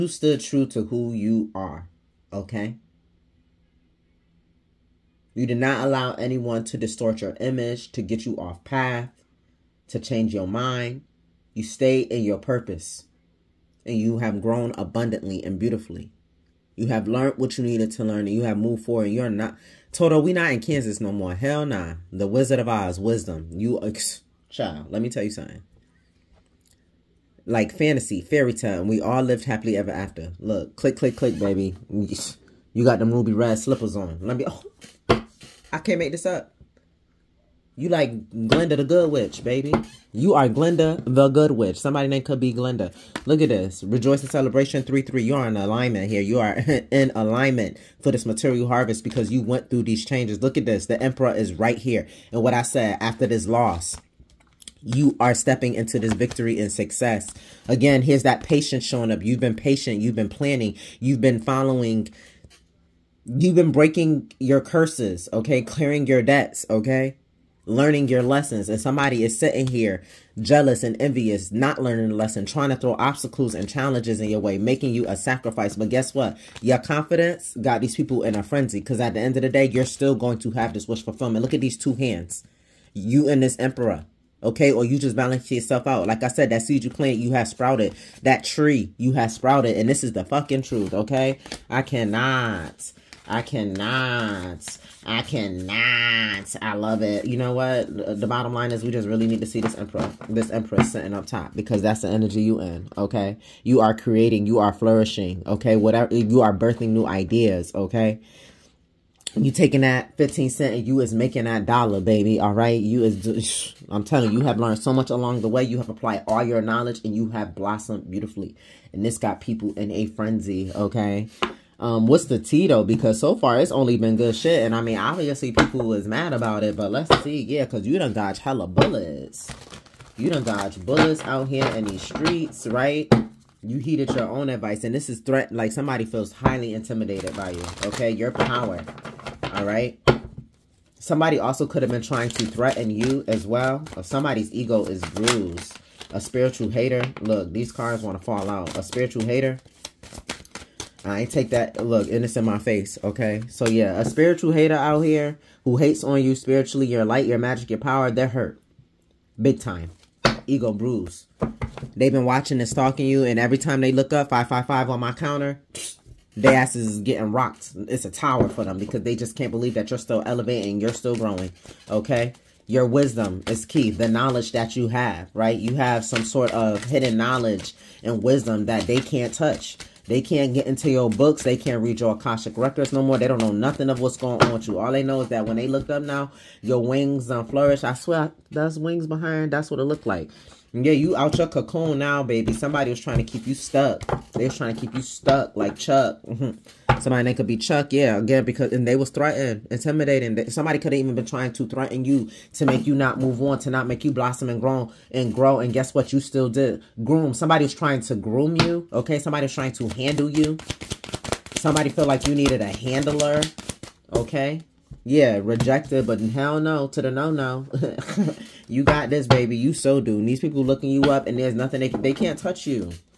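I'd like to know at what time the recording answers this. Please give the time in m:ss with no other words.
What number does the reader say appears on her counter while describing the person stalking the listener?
2:44.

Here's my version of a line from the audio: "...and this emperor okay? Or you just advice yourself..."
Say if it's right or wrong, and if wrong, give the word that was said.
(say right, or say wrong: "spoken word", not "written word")
wrong: "balance", not "advice".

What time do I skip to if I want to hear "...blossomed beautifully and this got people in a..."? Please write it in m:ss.
1:57.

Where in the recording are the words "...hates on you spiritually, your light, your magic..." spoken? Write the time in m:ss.
2:35.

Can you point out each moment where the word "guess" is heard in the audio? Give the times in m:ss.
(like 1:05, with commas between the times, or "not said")
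1:15, 3:25.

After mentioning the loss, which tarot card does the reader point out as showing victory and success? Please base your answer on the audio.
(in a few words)
The Emperor.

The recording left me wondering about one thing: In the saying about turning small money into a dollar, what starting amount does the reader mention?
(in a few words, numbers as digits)
15 cents.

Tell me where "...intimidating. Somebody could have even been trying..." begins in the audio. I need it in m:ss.
3:19.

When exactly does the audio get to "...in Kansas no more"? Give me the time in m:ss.
0:20.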